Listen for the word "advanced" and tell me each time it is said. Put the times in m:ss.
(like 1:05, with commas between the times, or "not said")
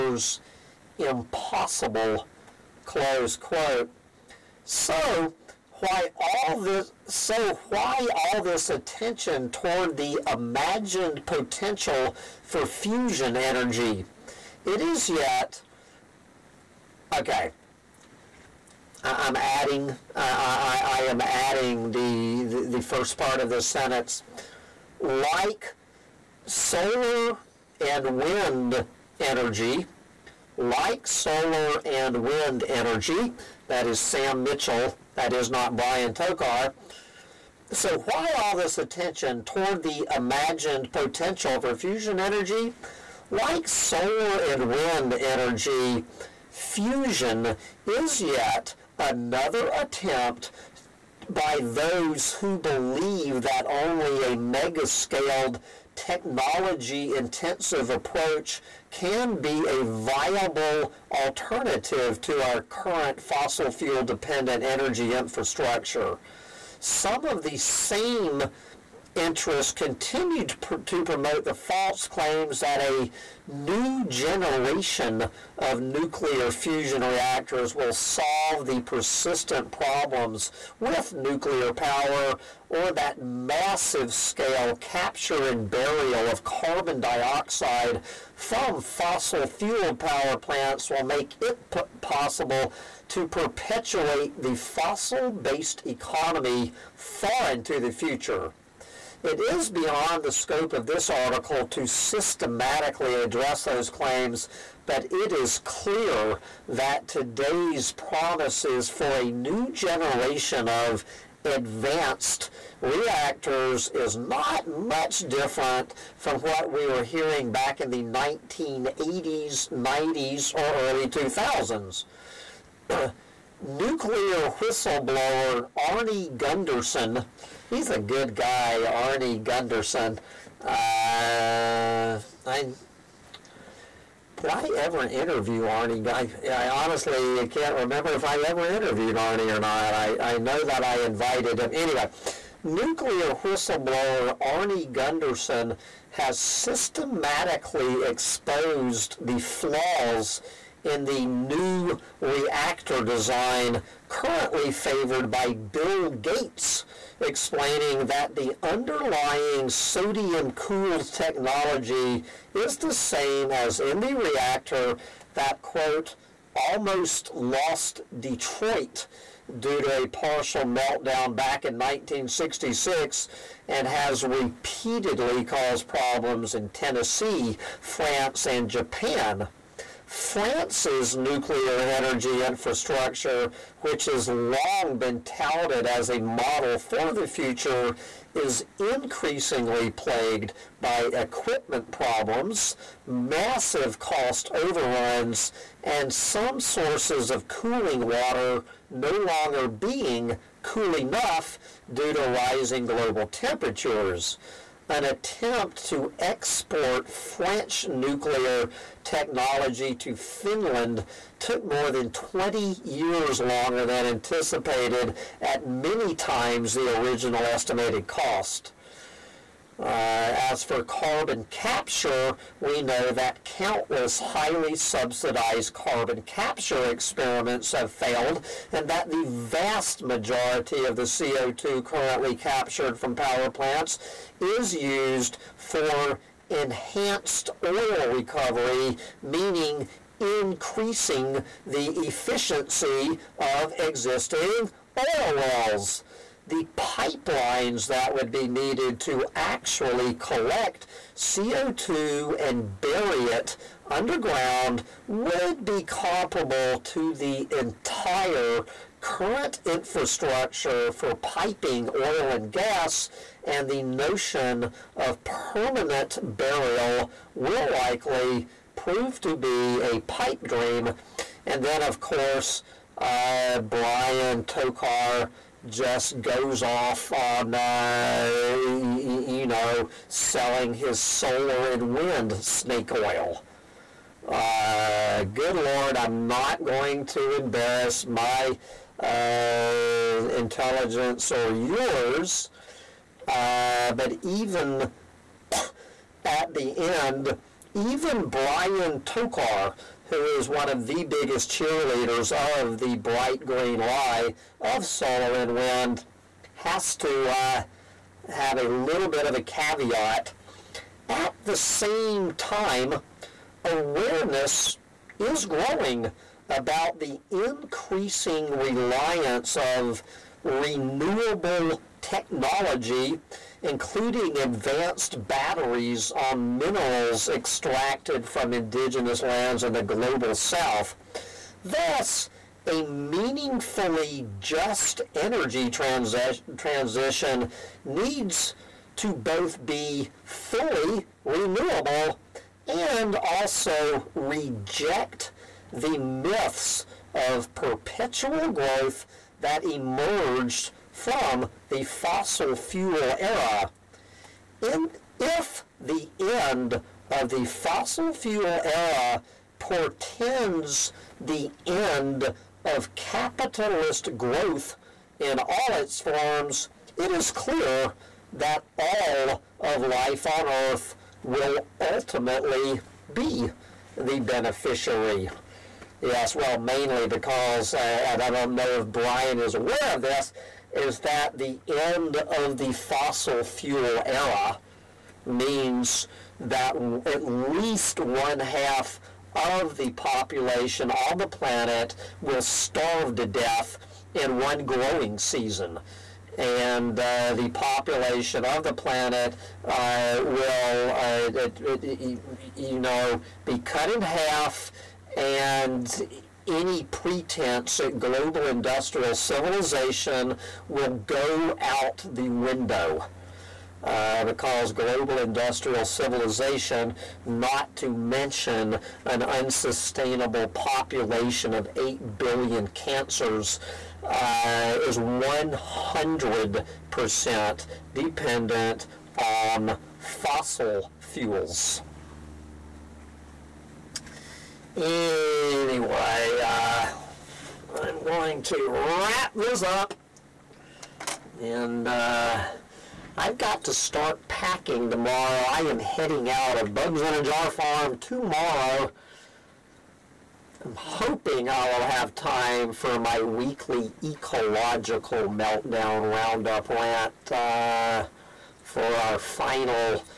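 1:51, 5:24.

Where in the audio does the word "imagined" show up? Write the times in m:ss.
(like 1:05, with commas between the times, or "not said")
0:10, 0:40.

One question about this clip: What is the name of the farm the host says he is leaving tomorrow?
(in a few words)
Bugs in a Jar Farm.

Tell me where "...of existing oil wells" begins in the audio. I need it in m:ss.
4:03.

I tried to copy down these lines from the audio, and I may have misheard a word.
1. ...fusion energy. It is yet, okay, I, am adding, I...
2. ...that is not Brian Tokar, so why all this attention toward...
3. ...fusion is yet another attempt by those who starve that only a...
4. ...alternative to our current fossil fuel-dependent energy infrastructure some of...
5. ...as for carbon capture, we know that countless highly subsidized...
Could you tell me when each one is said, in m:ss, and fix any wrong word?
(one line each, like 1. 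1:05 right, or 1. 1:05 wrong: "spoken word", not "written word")
1. 0:12 right
2. 0:35 right
3. 0:46 wrong: "believe", not "starve"
4. 1:01 right
5. 3:40 right.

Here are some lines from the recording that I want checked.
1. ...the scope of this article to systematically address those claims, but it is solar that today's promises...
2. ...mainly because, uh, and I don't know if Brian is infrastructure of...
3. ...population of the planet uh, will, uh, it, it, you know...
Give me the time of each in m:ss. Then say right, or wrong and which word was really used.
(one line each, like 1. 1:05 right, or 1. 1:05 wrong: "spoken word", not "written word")
1. 1:40 wrong: "clear", not "solar"
2. 6:16 wrong: "aware", not "infrastructure"
3. 6:37 right.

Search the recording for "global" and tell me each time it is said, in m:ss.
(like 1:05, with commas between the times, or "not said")
3:22, 5:29, 6:47, 6:54.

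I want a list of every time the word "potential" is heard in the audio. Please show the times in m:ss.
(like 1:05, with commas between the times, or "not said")
0:11, 0:40.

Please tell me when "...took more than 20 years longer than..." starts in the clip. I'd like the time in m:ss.
3:31.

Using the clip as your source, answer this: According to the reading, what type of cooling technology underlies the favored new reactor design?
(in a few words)
sodium-cooled.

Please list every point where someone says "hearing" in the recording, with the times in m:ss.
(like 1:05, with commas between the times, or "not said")
1:57.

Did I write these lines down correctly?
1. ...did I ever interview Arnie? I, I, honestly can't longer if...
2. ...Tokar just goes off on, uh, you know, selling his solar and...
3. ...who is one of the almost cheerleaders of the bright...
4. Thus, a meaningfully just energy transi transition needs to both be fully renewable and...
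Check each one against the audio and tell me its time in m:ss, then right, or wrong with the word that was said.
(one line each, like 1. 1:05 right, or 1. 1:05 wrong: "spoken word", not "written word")
1. 2:14 wrong: "remember", not "longer"
2. 4:34 right
3. 5:00 wrong: "biggest", not "almost"
4. 5:31 right.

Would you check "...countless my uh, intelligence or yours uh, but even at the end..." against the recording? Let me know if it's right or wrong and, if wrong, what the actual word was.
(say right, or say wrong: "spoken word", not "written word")
wrong: "embarrass", not "countless".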